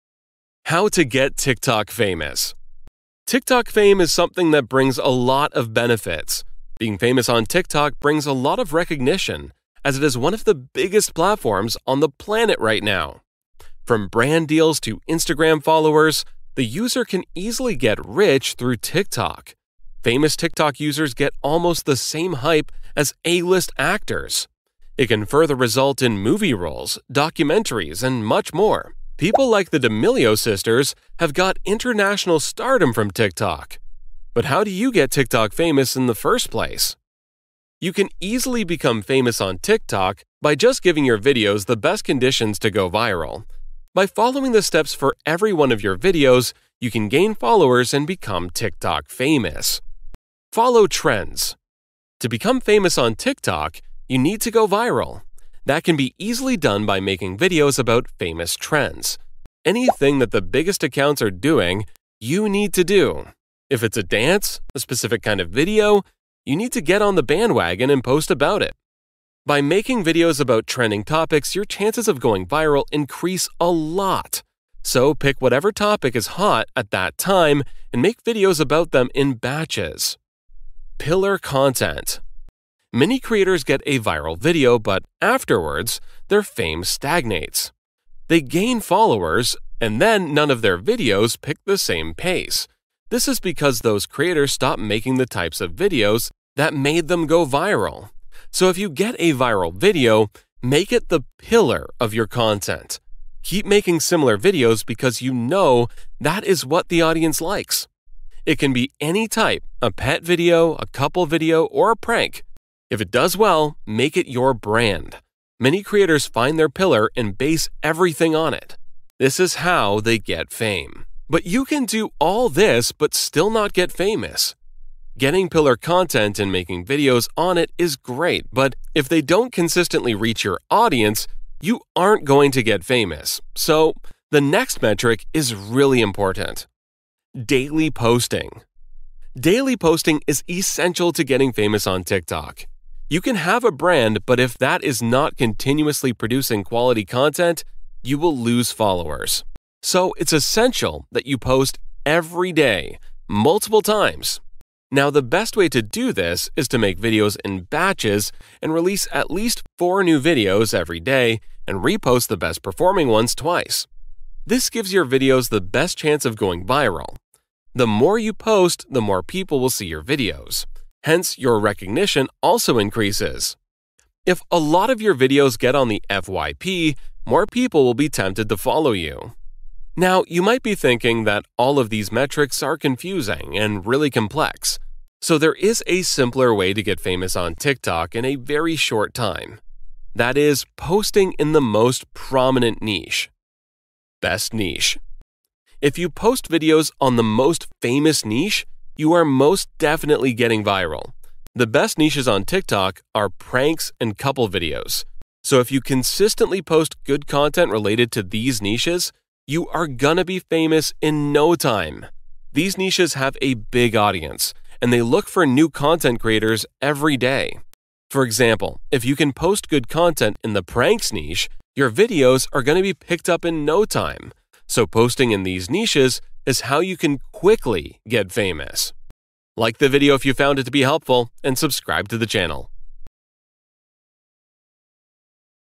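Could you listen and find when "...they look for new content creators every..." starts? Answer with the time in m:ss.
3:34.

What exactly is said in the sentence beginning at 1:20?
Pillar content many creators get a viral video, but afterwards, their fame stagnates.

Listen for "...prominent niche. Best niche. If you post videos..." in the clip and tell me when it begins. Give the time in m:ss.
3:12.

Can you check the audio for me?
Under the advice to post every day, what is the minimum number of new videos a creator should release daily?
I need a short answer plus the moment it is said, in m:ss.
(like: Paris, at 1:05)
4, at 2:39.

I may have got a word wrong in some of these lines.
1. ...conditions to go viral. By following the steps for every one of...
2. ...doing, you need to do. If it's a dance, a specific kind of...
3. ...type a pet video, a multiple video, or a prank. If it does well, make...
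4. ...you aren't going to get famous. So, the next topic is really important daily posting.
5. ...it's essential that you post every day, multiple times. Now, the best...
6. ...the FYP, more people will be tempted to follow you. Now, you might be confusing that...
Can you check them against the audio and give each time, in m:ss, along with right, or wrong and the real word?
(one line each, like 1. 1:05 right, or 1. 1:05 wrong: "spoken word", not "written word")
1. 0:42 right
2. 1:01 right
3. 1:49 wrong: "couple", not "multiple"
4. 2:11 wrong: "metric", not "topic"
5. 2:30 right
6. 2:55 wrong: "thinking", not "confusing".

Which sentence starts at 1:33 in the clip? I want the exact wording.
This is because those creators stop making the types of videos that made them go viral.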